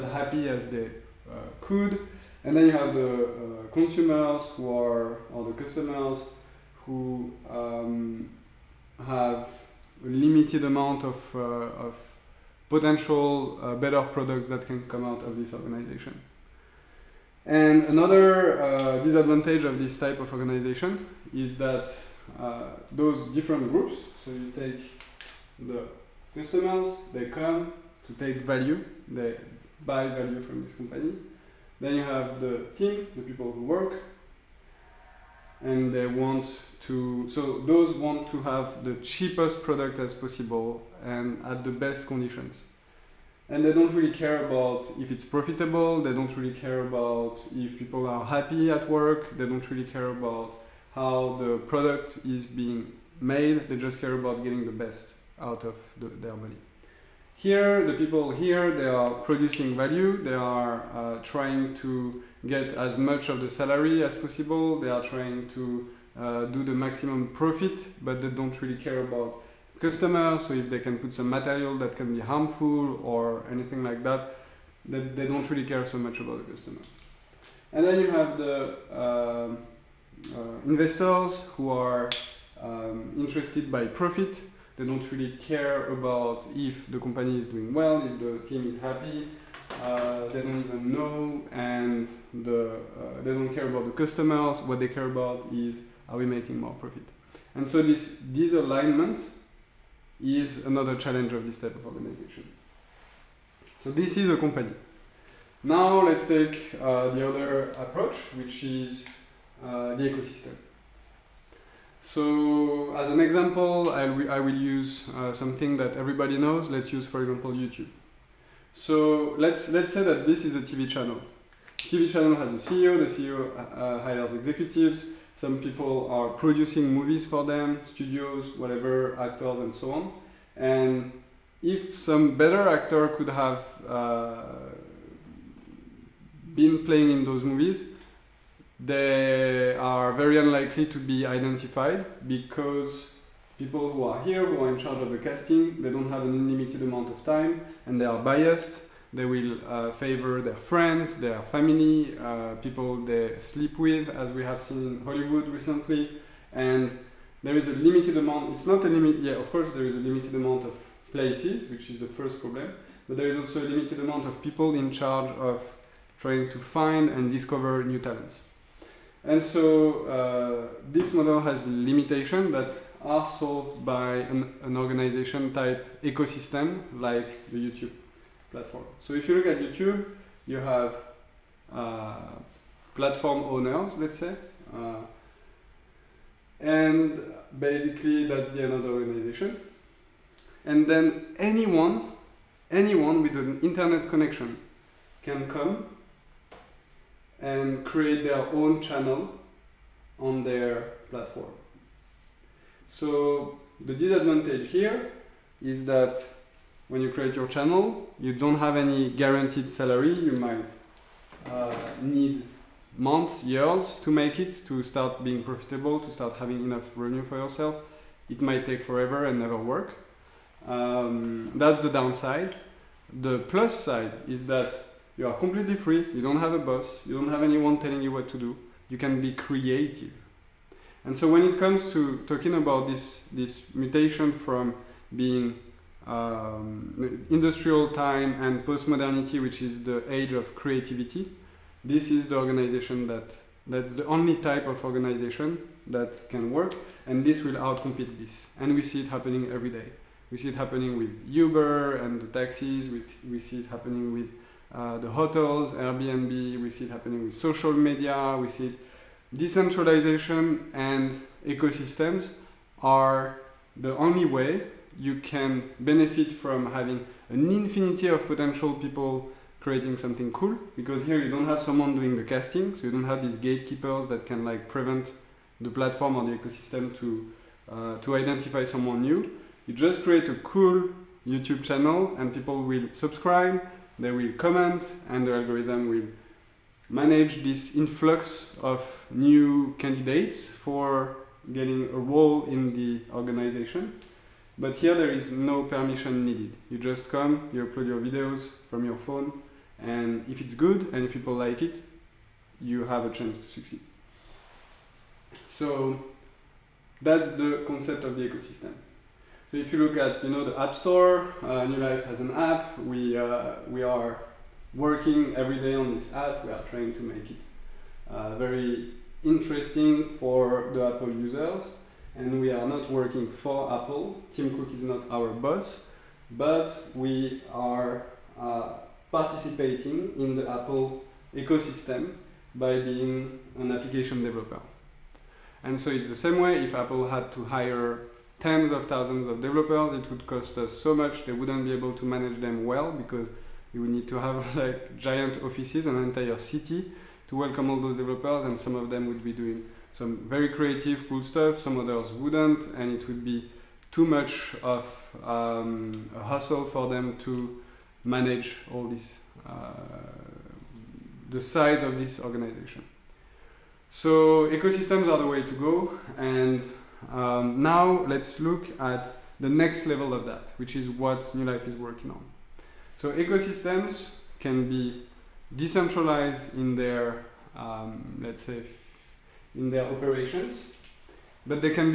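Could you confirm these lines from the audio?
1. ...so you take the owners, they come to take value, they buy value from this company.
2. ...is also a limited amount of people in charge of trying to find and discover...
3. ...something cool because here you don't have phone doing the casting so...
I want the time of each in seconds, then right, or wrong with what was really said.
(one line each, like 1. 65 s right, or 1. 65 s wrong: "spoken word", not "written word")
1. 24 s wrong: "customers", not "owners"
2. 163 s right
3. 269 s wrong: "someone", not "phone".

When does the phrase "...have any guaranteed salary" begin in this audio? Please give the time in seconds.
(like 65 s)
208 s.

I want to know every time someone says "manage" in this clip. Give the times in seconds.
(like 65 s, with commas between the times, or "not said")
286 s, 342 s, 358 s.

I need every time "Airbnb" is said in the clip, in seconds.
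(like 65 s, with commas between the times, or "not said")
255 s.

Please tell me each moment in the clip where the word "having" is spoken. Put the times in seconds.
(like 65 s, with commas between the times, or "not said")
216 s, 266 s.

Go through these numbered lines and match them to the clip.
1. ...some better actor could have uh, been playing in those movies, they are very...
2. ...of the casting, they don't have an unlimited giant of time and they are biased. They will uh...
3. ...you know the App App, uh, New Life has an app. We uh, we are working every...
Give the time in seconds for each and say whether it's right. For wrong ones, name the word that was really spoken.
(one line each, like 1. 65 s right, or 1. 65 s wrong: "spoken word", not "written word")
1. 131 s right
2. 145 s wrong: "amount", not "giant"
3. 310 s wrong: "Store", not "App".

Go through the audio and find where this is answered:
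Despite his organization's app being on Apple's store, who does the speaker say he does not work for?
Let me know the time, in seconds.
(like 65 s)
324 s.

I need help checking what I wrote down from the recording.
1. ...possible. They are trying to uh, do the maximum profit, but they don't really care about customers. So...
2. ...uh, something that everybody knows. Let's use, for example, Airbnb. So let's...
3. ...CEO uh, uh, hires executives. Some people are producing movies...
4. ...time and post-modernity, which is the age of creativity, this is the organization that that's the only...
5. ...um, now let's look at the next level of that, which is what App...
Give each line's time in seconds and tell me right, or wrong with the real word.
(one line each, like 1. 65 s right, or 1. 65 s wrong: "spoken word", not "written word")
1. 64 s right
2. 115 s wrong: "YouTube", not "Airbnb"
3. 123 s right
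4. 237 s right
5. 367 s wrong: "New", not "App".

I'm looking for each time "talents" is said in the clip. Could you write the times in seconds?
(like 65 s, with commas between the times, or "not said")
167 s.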